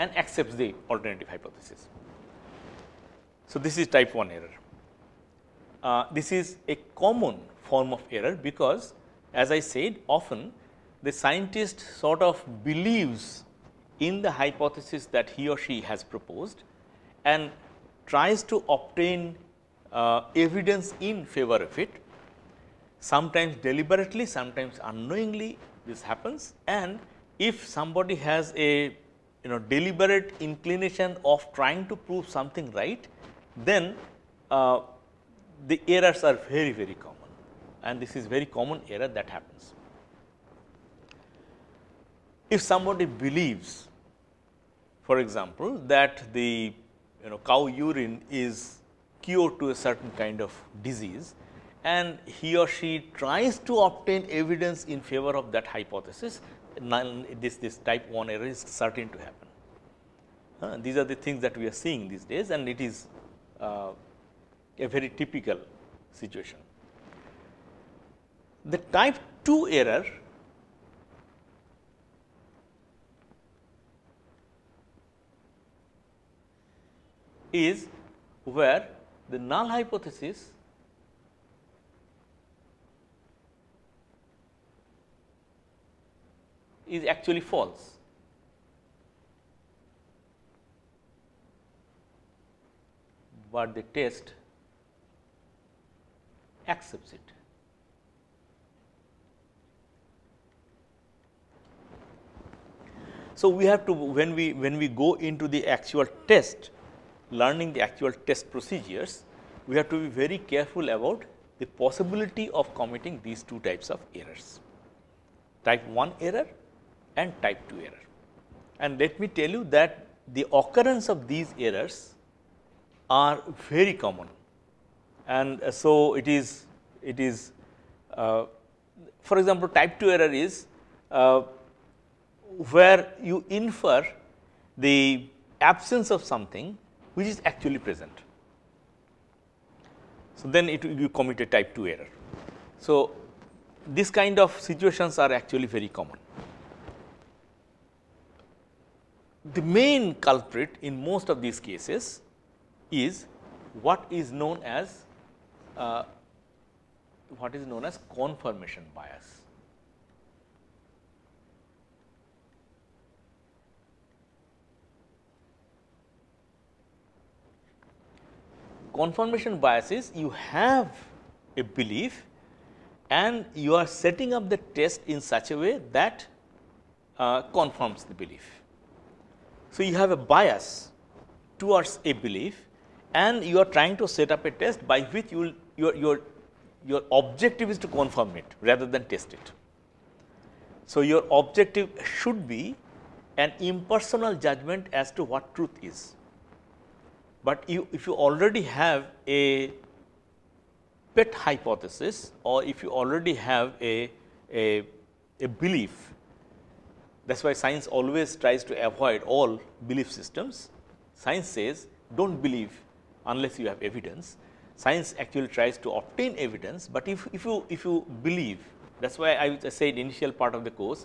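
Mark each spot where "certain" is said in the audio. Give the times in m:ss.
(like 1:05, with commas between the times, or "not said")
0:49, 0:58.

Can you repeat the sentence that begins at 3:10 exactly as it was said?
So, your objective should be an impersonal judgment as to what truth is.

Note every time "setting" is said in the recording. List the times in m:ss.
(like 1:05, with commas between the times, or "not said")
2:53.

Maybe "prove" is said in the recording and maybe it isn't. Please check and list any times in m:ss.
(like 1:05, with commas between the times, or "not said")
0:31.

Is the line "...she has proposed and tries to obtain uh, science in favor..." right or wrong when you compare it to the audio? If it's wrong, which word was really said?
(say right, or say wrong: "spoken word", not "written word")
wrong: "evidence", not "science".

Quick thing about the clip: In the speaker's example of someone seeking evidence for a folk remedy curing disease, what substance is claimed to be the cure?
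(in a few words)
cow urine.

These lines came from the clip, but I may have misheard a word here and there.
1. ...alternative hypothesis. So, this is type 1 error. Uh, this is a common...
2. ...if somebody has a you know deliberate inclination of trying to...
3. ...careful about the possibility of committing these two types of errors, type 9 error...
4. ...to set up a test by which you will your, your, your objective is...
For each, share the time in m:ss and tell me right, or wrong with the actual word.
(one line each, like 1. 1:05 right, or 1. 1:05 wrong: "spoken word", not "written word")
1. 0:00 right
2. 0:27 right
3. 1:50 wrong: "1", not "9"
4. 3:03 right.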